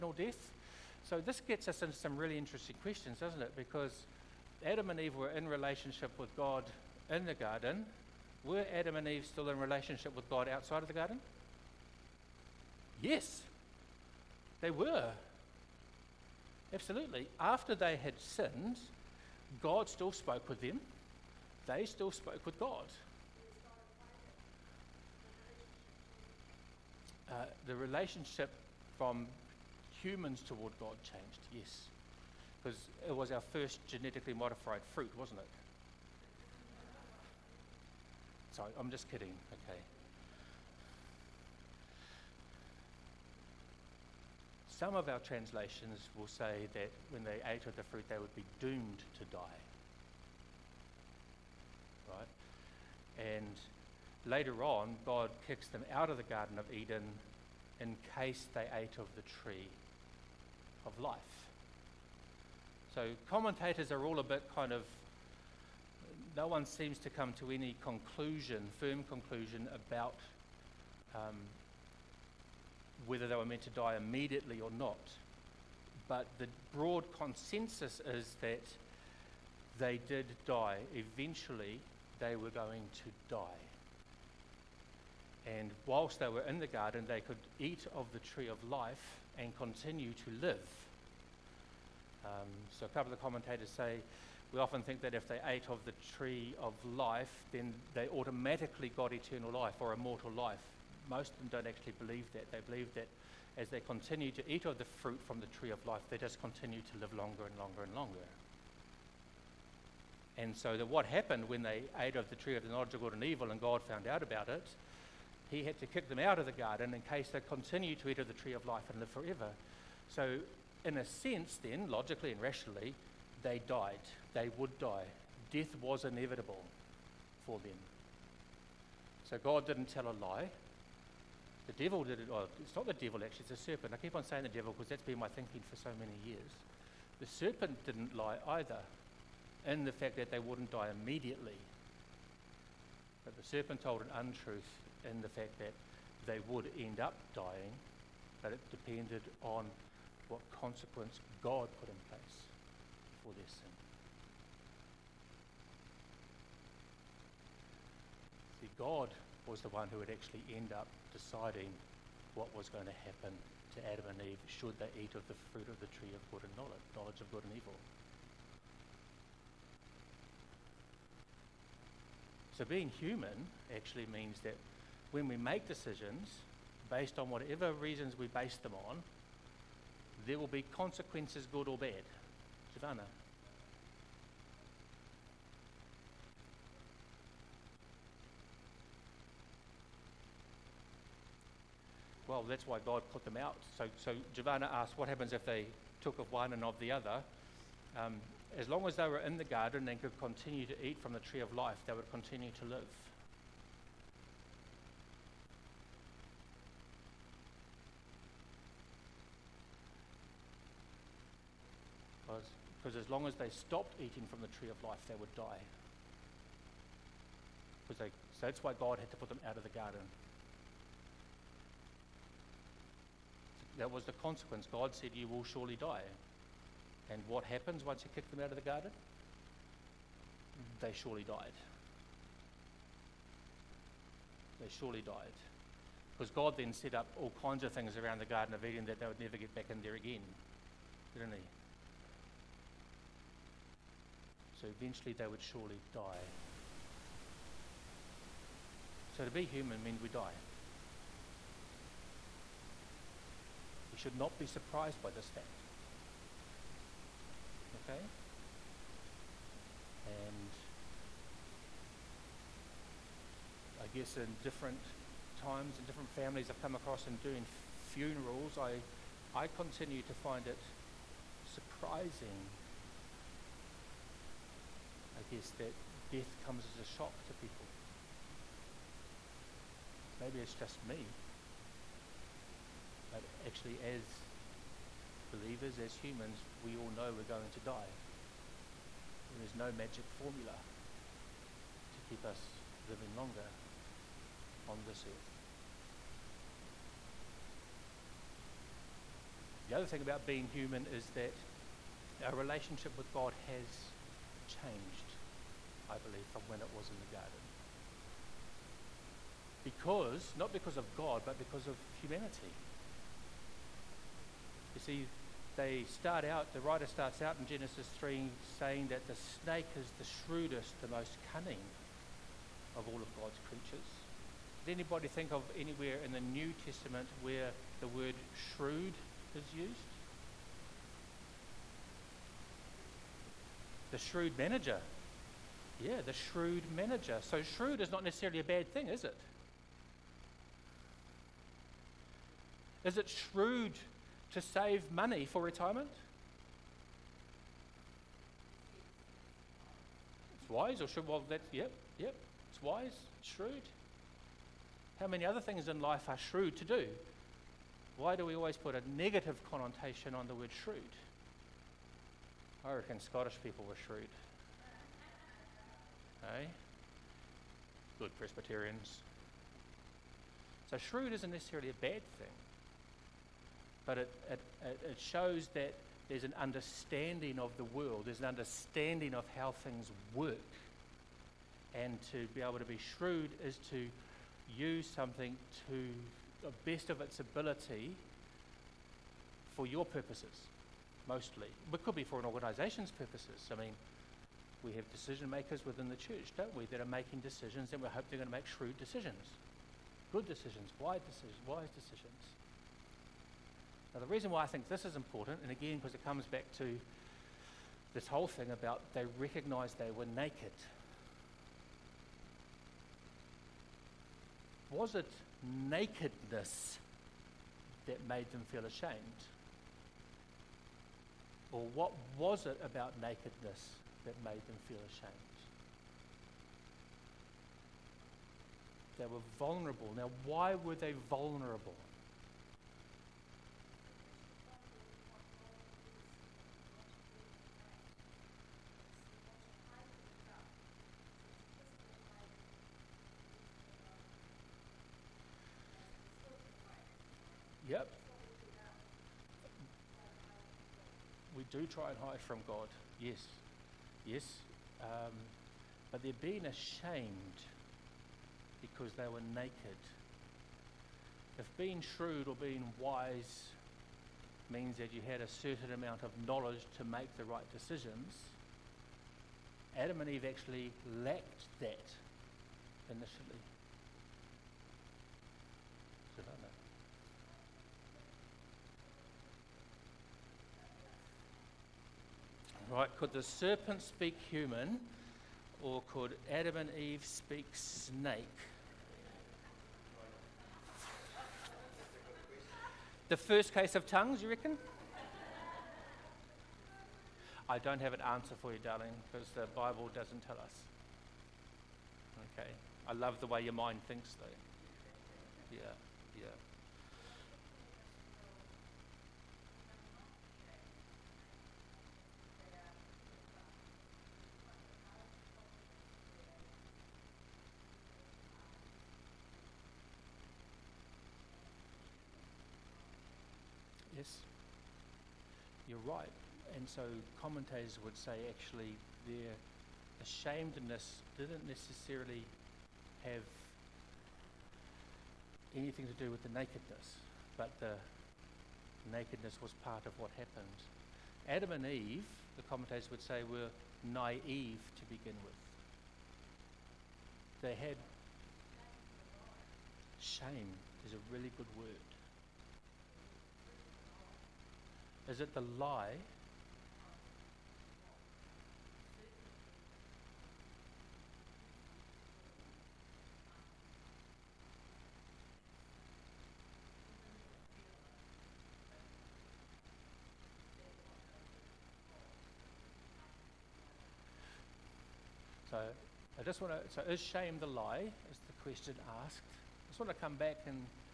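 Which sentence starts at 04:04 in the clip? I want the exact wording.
So eventually they would surely die.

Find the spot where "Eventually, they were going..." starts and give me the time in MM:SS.
01:20.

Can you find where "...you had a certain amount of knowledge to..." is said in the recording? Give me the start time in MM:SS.
07:44.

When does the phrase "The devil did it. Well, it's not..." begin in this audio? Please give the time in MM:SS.
02:11.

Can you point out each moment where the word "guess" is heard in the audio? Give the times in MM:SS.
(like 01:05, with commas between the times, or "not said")
04:23, 04:35.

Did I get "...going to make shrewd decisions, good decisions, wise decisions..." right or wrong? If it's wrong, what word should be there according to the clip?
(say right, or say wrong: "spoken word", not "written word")
right.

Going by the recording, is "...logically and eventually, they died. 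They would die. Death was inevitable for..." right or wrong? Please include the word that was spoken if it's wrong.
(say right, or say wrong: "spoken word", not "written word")
wrong: "rationally", not "eventually".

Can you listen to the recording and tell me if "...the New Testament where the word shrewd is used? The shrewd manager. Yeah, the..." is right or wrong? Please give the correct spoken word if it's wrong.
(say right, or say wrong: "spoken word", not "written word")
right.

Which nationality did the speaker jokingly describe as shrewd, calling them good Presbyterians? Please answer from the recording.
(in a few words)
Scottish.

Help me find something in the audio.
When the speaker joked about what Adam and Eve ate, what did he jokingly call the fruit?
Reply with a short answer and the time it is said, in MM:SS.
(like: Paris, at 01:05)
genetically modified fruit, at 00:33.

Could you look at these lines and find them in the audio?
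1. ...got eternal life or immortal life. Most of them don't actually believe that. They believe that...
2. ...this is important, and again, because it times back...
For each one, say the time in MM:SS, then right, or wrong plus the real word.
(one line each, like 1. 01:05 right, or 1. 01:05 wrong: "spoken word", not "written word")
1. 01:38 right
2. 06:44 wrong: "comes", not "times".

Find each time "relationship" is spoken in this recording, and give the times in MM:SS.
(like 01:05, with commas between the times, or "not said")
00:05, 00:09, 00:27, 05:02.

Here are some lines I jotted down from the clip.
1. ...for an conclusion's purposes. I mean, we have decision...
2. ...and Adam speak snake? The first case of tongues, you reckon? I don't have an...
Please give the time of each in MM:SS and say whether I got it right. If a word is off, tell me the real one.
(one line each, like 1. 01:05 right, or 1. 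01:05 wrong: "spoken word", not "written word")
1. 06:32 wrong: "organisation", not "conclusion"
2. 08:06 wrong: "Eve", not "Adam".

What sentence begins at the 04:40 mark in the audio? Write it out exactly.
Maybe it's just me, but actually, as believers, as humans, we all know we're going to die.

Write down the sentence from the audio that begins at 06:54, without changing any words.
Was it nakedness that made them feel ashamed?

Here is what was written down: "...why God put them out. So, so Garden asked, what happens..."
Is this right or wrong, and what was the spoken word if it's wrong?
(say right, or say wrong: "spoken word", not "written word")
wrong: "Giovanna", not "Garden".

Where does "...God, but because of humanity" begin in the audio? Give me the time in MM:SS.
05:10.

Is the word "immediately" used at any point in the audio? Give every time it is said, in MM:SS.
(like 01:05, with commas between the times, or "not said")
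01:13, 02:21.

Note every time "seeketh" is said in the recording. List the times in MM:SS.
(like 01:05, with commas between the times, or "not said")
not said.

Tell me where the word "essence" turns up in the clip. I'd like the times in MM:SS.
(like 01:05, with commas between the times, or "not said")
not said.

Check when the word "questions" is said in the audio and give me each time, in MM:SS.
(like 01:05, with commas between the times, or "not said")
00:02, 09:38.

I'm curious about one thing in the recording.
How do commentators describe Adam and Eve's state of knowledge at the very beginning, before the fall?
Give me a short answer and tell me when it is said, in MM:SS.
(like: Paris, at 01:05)
naive, at 09:03.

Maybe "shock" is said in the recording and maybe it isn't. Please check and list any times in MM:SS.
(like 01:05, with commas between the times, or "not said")
04:36.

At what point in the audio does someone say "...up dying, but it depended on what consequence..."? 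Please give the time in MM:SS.
02:26.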